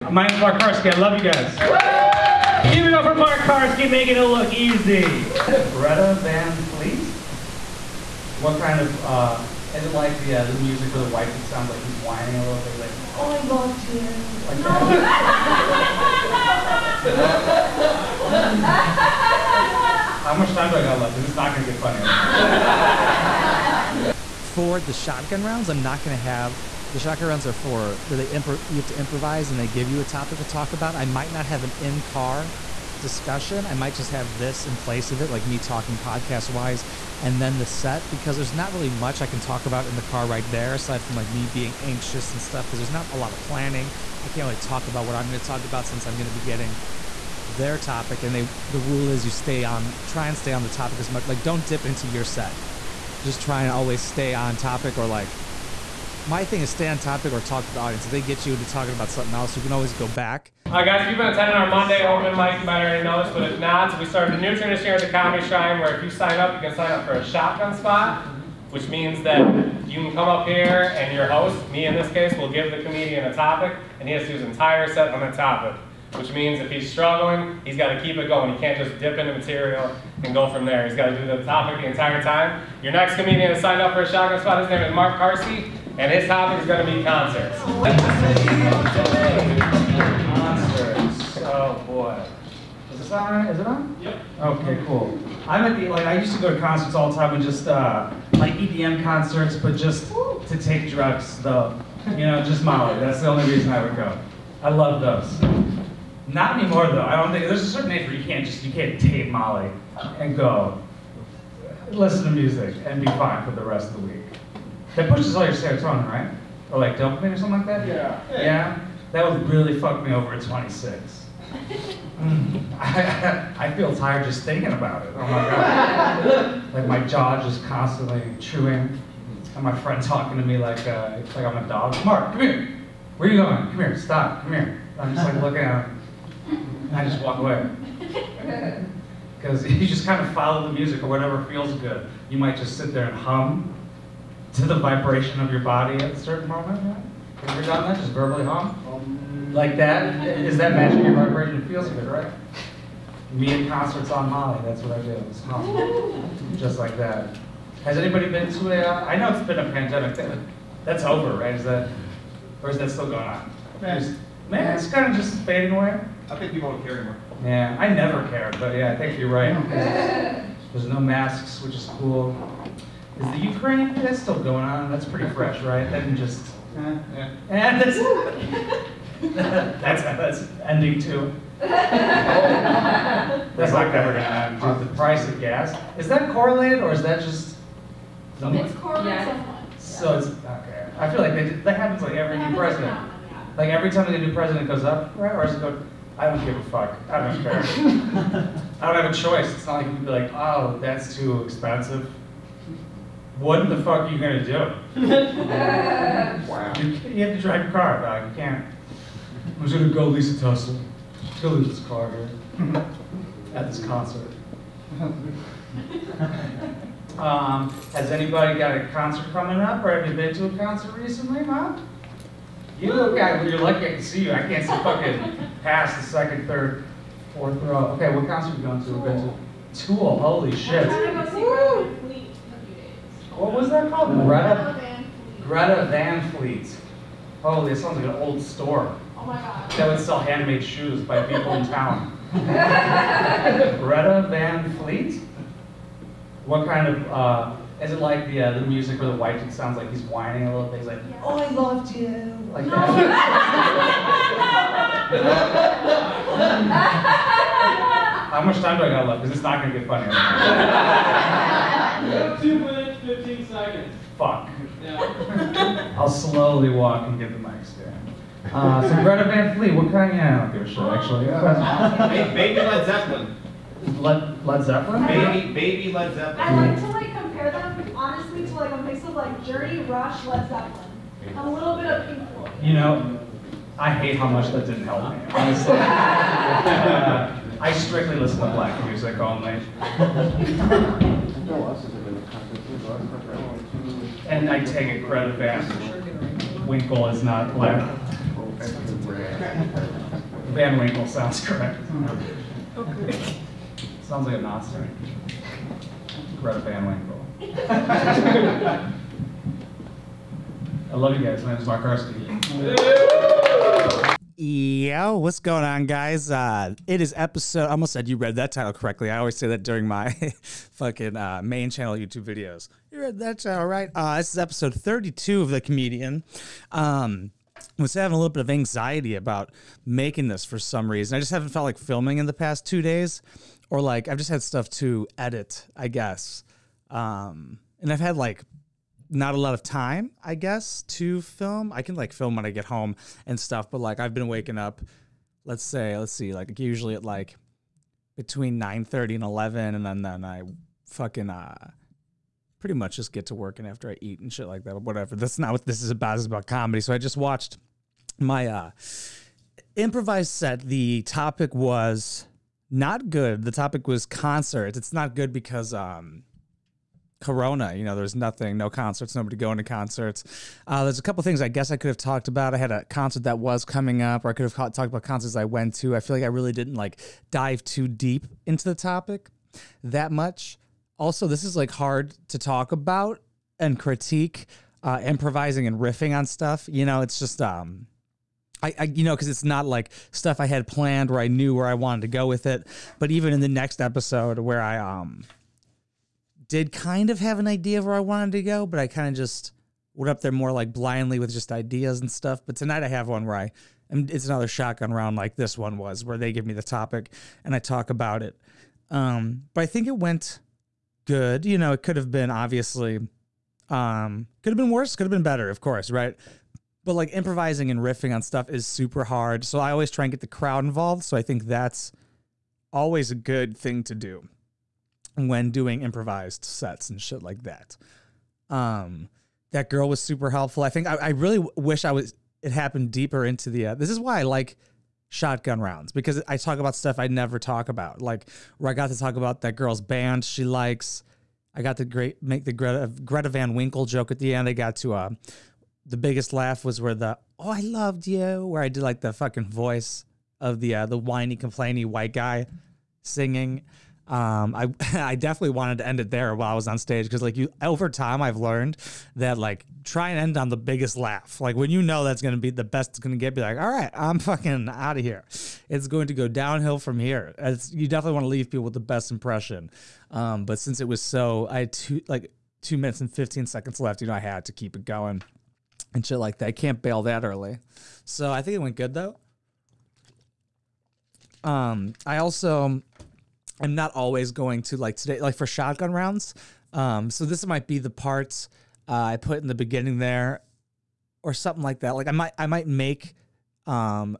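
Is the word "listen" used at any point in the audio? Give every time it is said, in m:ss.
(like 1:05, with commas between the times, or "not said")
1:51, 4:48.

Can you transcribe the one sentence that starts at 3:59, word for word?
That would sell handmade shoes by people in town.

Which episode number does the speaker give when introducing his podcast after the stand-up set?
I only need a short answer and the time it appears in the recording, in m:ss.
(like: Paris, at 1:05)
32, at 5:24.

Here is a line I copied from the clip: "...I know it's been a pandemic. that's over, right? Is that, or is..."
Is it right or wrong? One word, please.
right.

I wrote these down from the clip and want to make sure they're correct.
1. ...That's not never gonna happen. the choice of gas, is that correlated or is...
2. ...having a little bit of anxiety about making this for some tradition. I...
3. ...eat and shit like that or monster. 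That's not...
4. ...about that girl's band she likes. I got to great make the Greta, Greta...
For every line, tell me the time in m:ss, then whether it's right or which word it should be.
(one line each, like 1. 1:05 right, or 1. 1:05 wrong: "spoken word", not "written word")
1. 3:01 wrong: "price", not "choice"
2. 5:27 wrong: "reason", not "tradition"
3. 5:54 wrong: "whatever", not "monster"
4. 7:19 right.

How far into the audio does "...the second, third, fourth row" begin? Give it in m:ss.
3:45.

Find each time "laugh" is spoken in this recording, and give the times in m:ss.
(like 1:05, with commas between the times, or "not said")
7:26, 7:40.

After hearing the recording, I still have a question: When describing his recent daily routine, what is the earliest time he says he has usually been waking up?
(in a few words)
9:30.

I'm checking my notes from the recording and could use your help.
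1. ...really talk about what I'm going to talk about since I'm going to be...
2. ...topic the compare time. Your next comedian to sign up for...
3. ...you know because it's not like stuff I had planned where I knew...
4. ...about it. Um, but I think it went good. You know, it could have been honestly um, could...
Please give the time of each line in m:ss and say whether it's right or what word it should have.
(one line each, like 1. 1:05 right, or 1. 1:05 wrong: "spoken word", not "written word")
1. 0:44 right
2. 1:21 wrong: "entire", not "compare"
3. 6:28 right
4. 6:47 wrong: "obviously", not "honestly".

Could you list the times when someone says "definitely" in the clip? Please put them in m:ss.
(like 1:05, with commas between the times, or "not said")
7:35, 7:47.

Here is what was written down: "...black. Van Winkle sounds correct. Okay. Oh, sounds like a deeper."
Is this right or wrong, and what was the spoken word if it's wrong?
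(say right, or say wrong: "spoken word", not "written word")
wrong: "monster", not "deeper".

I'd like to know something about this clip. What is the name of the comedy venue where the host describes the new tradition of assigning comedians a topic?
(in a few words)
Comedy Shrine.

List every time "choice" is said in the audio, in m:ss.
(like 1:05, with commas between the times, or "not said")
3:19.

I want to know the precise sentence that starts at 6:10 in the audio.
Uh, there's a couple things I guess I could have talked about.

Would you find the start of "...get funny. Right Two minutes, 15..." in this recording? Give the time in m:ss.
4:19.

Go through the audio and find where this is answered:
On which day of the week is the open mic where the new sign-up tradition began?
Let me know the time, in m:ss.
1:01.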